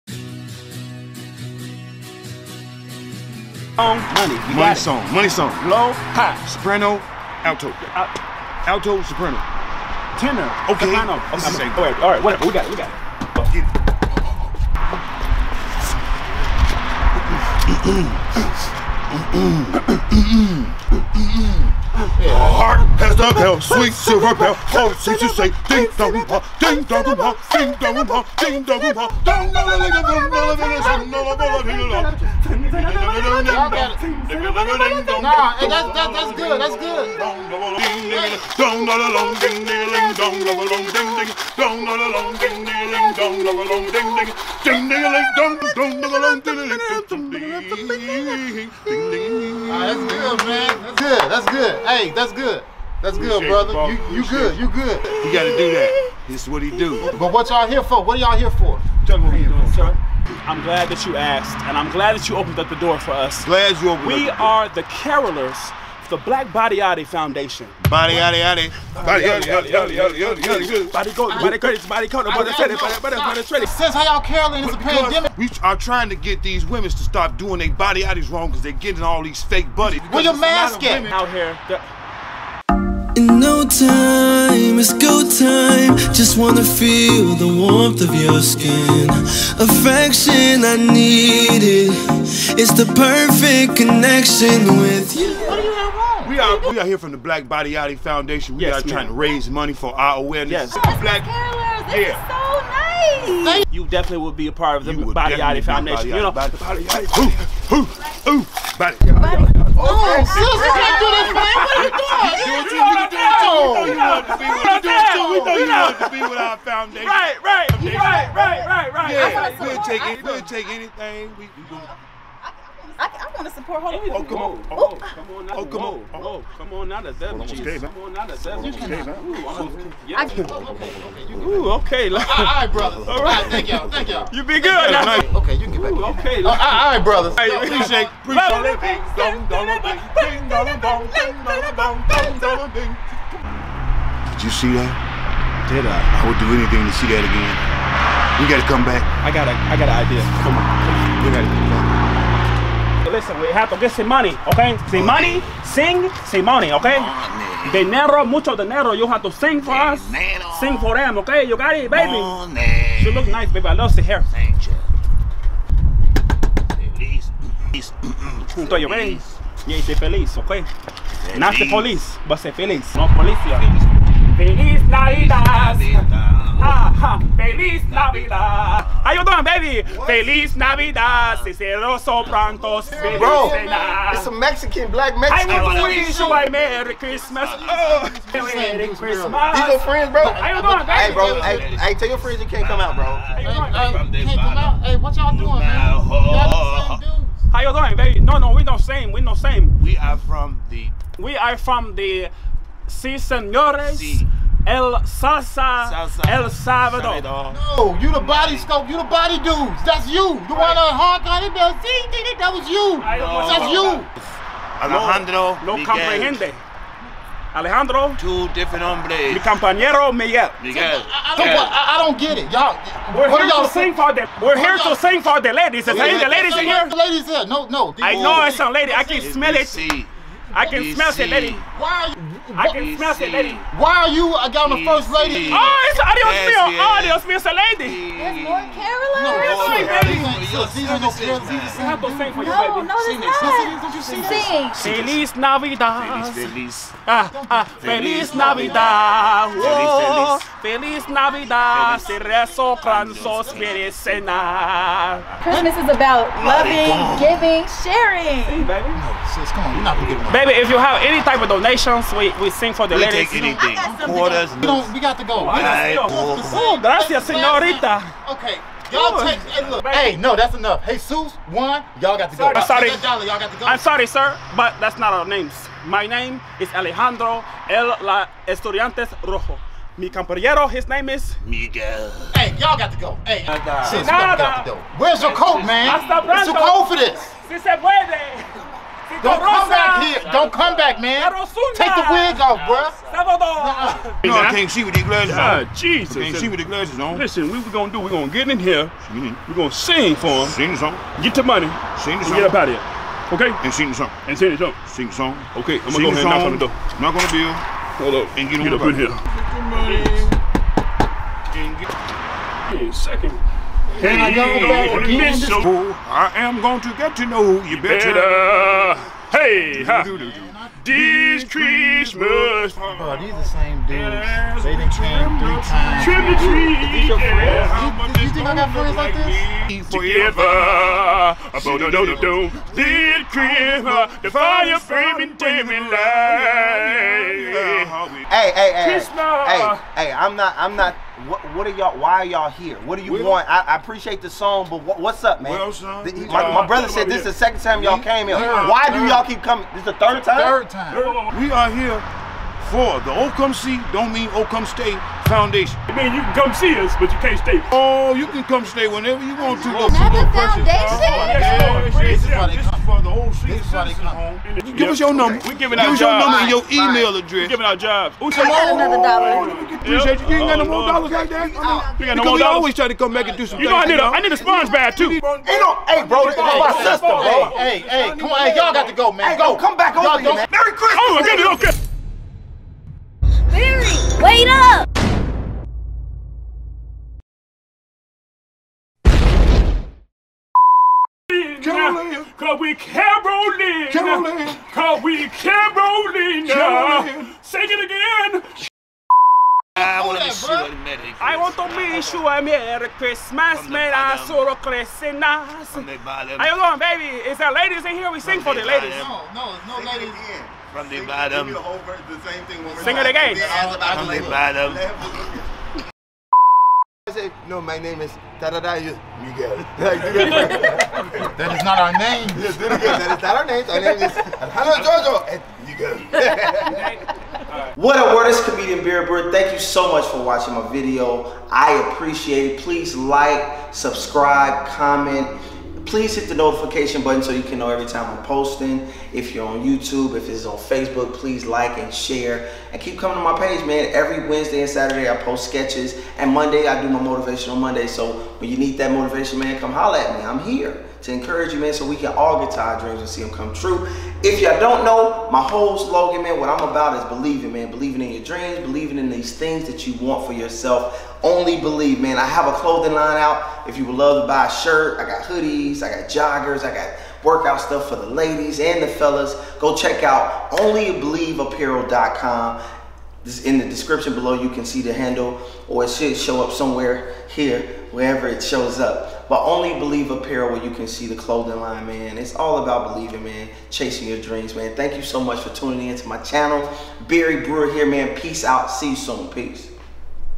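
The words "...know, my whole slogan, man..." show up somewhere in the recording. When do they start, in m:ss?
7:34.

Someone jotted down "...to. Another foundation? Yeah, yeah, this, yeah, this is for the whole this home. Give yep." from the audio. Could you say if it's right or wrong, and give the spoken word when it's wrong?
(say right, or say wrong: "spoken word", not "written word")
right.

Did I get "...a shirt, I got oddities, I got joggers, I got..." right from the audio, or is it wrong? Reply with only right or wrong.
wrong.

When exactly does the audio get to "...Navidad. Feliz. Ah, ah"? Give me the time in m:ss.
4:05.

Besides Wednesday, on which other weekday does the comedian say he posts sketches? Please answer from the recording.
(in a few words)
Saturday.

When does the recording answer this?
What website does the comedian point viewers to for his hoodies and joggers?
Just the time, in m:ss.
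7:50.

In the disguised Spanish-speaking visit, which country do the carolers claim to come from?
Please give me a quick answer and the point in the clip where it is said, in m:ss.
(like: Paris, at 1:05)
El Salvador, at 3:26.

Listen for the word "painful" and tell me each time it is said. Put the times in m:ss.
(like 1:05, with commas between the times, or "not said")
not said.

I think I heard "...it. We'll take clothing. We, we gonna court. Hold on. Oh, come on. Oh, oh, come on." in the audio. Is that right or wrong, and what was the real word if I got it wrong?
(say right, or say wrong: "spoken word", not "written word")
wrong: "anything", not "clothing".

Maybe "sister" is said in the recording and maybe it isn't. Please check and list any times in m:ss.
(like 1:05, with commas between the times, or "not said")
1:50, 6:16.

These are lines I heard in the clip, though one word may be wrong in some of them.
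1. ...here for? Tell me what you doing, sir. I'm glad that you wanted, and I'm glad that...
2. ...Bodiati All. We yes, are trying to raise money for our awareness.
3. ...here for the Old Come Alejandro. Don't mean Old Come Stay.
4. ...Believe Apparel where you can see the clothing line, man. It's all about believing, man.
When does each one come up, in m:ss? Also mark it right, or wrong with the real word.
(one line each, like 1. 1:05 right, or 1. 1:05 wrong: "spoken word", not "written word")
1. 0:58 wrong: "asked", not "wanted"
2. 1:37 wrong: "Foundation", not "All"
3. 5:51 wrong: "See", not "Alejandro"
4. 7:59 right.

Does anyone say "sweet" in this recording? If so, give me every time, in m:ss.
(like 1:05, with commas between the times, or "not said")
0:23.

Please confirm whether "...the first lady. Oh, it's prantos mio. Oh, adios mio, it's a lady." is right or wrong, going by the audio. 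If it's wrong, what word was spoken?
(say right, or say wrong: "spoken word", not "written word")
wrong: "adios", not "prantos".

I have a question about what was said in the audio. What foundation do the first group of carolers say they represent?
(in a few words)
Black Body Bodyati Foundation.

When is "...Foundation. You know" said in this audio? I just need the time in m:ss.
1:45.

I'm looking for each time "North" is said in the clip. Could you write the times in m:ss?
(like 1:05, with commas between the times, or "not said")
3:58.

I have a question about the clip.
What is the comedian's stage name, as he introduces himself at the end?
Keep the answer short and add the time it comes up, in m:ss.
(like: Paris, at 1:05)
Beer Bird, at 7:08.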